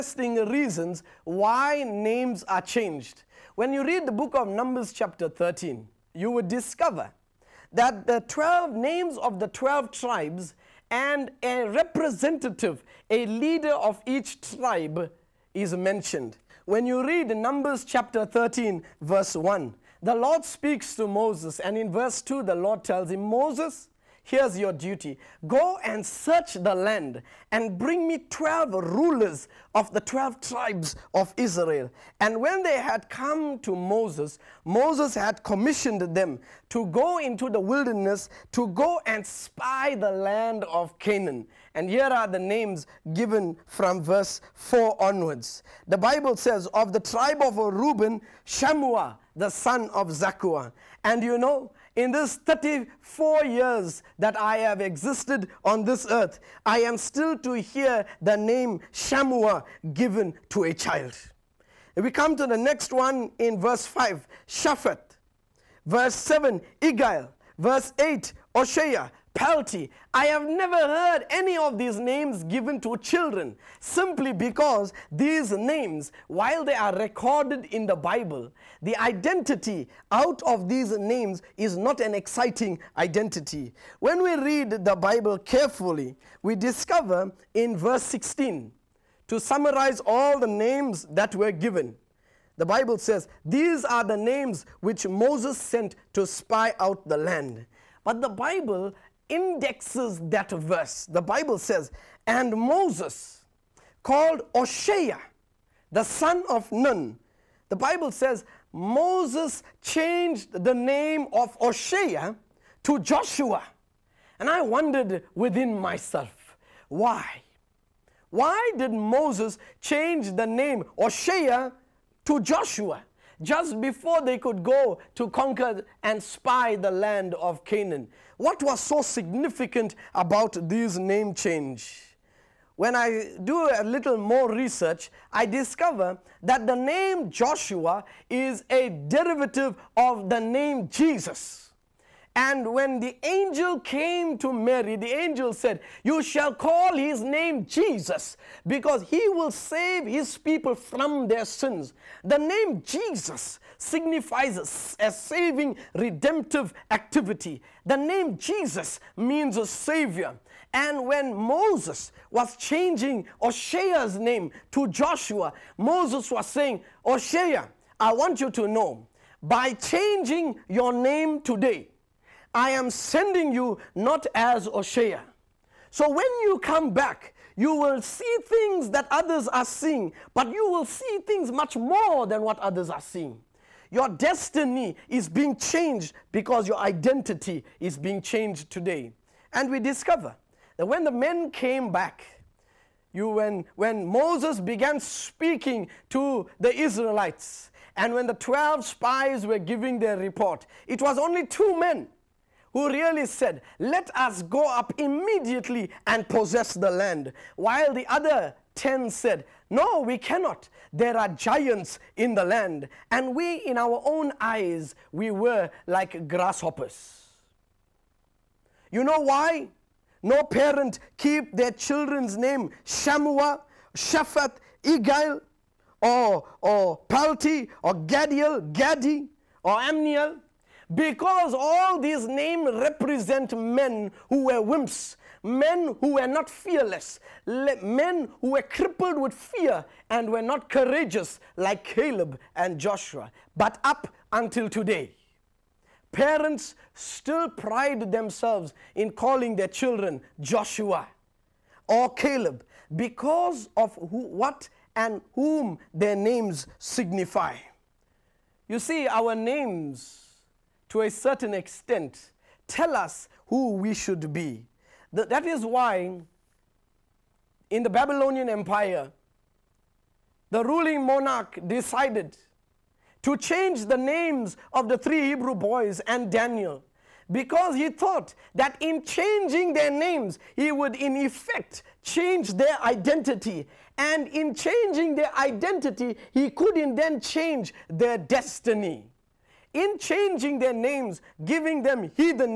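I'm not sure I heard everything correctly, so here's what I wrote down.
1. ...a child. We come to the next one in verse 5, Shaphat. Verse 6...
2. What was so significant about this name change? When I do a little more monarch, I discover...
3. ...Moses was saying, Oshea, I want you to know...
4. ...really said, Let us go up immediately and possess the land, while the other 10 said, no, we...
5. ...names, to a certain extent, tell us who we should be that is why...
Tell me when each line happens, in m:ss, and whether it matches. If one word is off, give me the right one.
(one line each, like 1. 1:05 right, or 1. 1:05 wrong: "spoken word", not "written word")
1. 1:00 wrong: "7", not "6"
2. 2:08 wrong: "research", not "monarch"
3. 2:45 right
4. 3:22 right
5. 4:19 right.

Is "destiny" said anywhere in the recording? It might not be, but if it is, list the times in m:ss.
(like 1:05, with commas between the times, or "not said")
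3:04, 4:48.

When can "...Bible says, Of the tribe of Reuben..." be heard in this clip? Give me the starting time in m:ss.
0:45.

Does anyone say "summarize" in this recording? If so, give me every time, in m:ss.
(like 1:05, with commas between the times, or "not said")
1:29.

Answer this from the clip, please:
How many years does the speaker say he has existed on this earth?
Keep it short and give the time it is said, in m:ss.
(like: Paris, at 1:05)
34, at 0:52.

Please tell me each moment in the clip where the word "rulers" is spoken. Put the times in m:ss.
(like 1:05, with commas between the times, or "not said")
0:28.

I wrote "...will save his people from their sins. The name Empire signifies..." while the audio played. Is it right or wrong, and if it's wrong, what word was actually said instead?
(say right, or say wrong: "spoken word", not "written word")
wrong: "Jesus", not "Empire".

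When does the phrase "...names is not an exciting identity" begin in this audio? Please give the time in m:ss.
1:20.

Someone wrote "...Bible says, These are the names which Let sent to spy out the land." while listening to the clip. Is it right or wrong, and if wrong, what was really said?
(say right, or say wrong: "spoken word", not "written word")
wrong: "Moses", not "Let".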